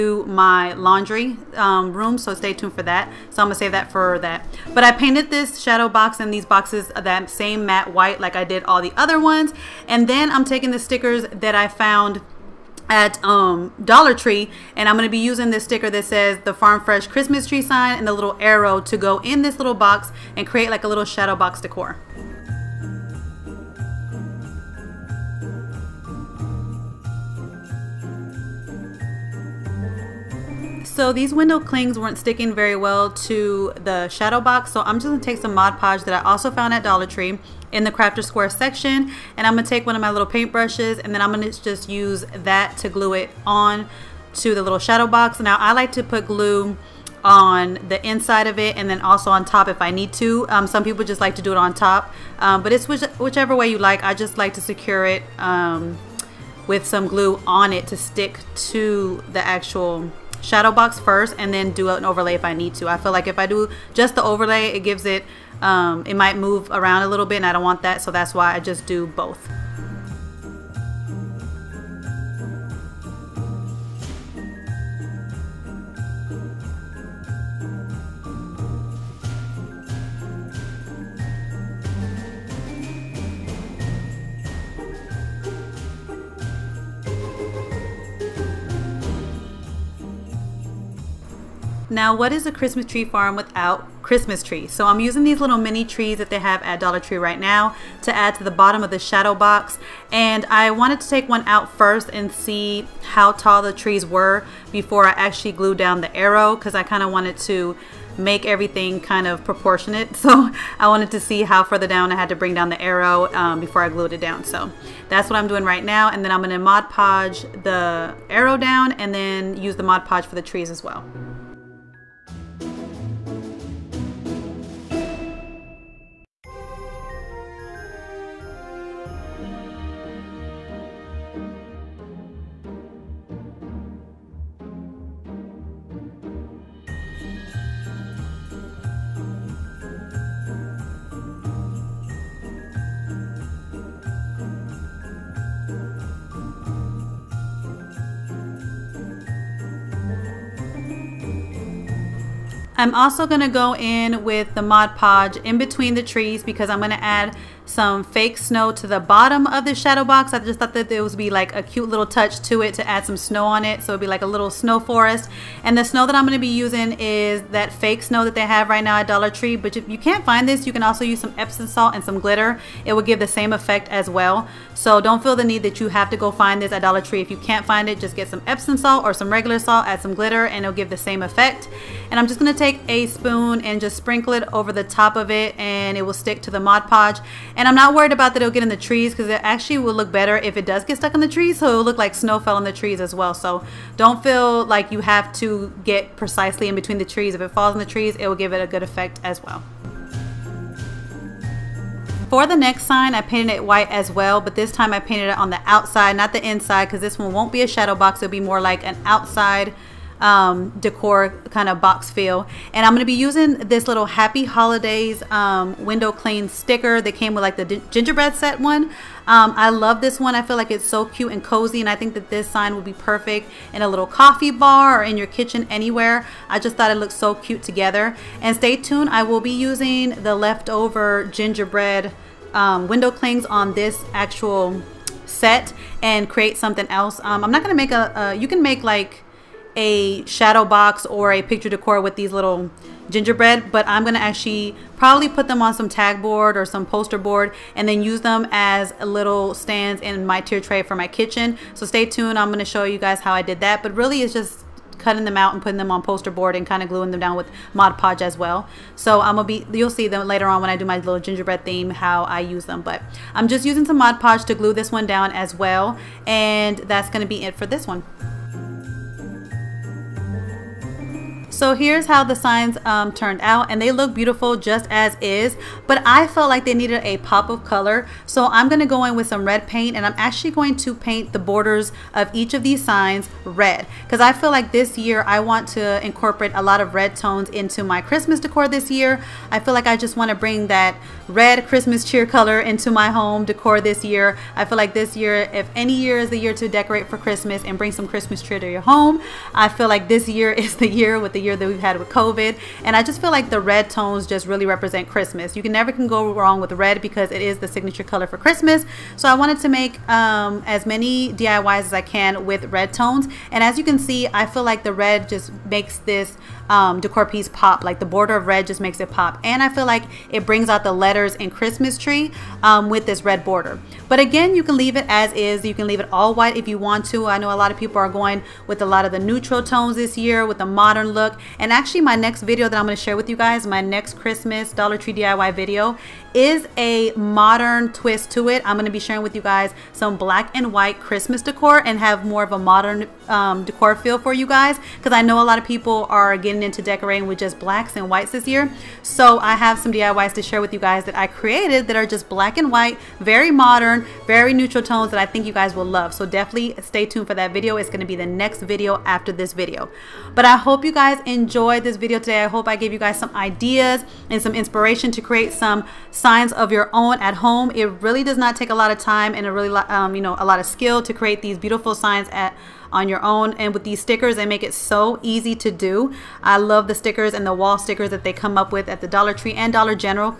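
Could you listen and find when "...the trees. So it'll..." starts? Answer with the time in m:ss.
3:11.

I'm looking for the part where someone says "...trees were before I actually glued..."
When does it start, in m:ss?
1:43.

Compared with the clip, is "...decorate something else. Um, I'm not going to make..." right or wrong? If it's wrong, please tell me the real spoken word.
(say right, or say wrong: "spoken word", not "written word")
wrong: "create", not "decorate".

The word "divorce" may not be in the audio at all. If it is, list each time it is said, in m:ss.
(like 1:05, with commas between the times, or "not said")
not said.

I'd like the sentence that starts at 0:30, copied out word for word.
So these window clings weren't sticking very well to the shadow box.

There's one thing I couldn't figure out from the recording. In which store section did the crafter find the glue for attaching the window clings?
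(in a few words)
crafter square section.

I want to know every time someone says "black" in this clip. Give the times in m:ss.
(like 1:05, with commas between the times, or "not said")
5:40, 5:47, 5:52.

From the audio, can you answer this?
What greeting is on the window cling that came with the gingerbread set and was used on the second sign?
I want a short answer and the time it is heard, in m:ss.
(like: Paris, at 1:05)
Happy Holidays, at 3:34.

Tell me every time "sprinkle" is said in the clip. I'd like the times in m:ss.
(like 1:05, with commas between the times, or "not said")
3:03.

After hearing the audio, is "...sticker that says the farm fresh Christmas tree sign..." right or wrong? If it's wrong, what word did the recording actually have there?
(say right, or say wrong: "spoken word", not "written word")
right.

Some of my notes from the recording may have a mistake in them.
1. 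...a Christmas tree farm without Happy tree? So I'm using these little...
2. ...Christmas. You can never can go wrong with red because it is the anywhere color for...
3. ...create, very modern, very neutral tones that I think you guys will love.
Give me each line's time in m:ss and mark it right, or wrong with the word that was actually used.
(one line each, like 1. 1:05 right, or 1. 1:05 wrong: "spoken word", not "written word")
1. 1:32 wrong: "Christmas", not "Happy"
2. 5:05 wrong: "signature", not "anywhere"
3. 5:52 wrong: "white", not "create".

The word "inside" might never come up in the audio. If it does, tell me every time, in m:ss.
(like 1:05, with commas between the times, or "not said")
0:48, 3:26.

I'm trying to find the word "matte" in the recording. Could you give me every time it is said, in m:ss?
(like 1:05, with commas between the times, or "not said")
0:07.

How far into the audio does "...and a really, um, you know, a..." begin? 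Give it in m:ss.
6:09.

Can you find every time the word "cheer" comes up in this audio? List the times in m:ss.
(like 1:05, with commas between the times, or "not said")
4:52, 4:58.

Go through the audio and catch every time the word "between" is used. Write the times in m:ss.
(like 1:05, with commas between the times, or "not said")
2:35, 3:16.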